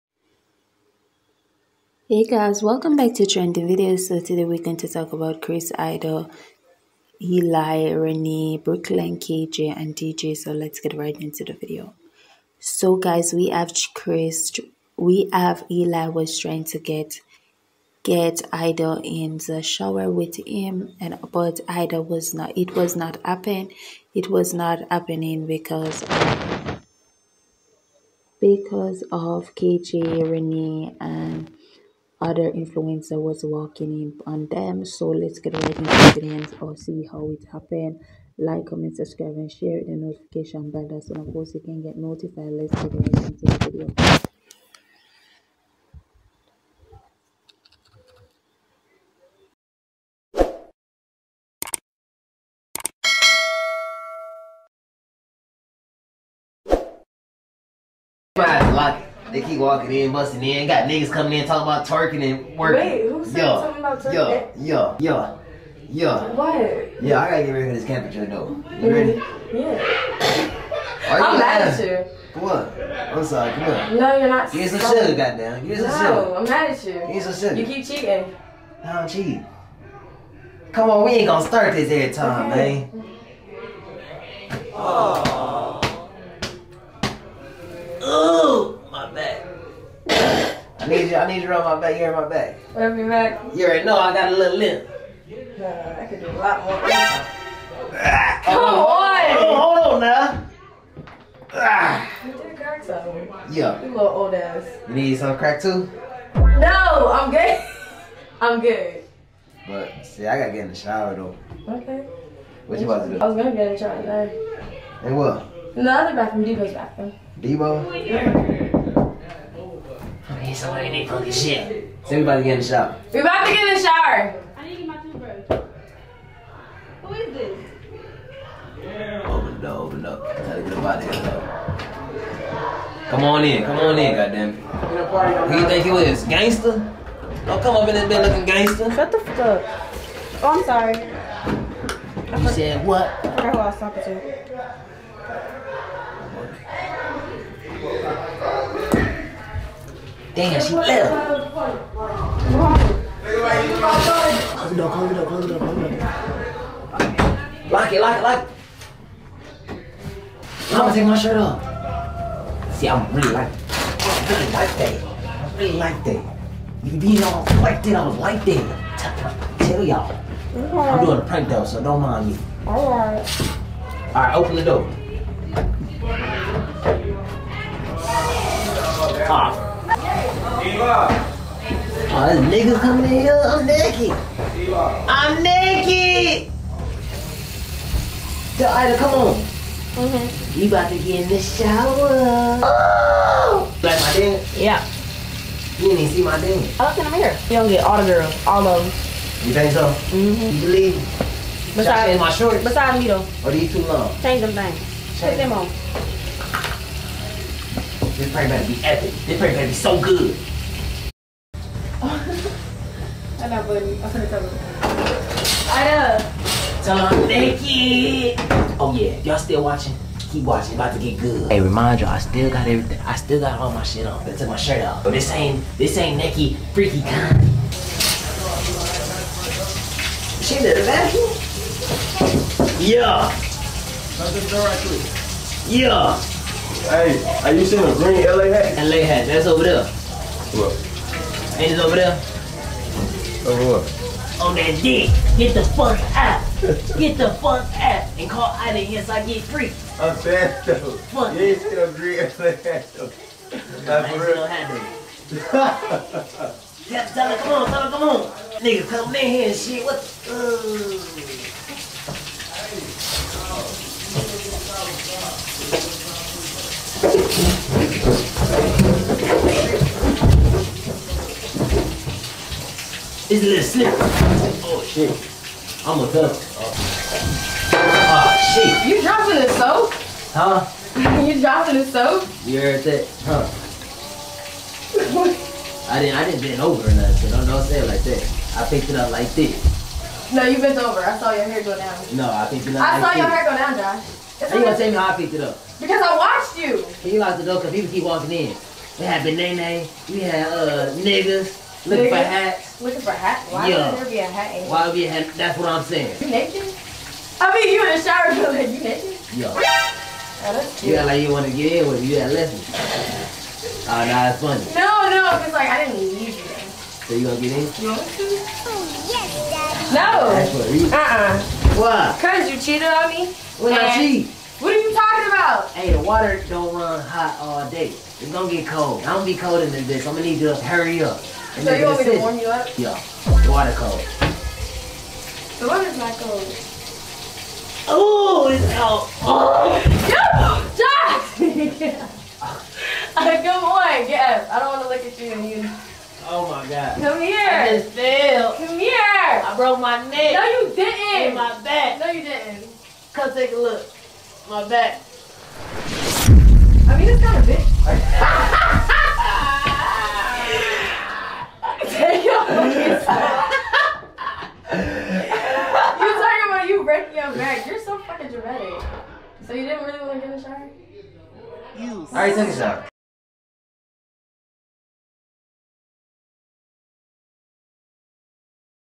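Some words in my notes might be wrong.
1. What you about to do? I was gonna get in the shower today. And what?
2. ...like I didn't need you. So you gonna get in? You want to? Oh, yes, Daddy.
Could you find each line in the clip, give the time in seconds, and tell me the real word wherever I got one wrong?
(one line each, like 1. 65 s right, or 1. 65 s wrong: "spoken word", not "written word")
1. 112 s right
2. 315 s right.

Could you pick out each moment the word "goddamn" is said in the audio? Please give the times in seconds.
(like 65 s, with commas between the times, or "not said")
75 s, 134 s.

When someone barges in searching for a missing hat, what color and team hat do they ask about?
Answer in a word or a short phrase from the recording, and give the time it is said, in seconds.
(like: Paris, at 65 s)
Green LA hat, at 237 s.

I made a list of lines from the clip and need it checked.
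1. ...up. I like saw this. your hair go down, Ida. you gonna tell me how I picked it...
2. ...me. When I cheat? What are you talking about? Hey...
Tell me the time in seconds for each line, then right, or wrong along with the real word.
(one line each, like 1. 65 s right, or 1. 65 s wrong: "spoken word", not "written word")
1. 292 s wrong: "Josh", not "Ida"
2. 323 s right.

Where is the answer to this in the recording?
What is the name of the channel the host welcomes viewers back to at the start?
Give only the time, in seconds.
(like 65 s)
3 s.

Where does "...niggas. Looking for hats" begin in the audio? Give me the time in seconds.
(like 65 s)
300 s.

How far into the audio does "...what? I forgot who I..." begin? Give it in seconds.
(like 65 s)
142 s.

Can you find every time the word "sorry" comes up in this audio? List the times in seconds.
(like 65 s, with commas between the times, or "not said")
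73 s, 140 s.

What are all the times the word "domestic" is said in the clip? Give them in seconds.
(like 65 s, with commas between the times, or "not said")
not said.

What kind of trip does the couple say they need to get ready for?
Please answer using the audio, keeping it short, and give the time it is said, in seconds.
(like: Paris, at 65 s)
Camping, at 67 s.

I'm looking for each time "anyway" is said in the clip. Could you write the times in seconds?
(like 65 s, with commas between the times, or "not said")
not said.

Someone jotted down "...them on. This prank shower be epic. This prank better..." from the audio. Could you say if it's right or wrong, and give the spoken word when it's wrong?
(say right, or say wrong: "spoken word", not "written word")
wrong: "better", not "shower".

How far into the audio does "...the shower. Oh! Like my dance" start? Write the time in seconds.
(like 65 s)
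191 s.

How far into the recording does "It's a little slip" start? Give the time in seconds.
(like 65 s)
273 s.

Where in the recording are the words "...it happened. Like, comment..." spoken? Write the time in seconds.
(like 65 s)
37 s.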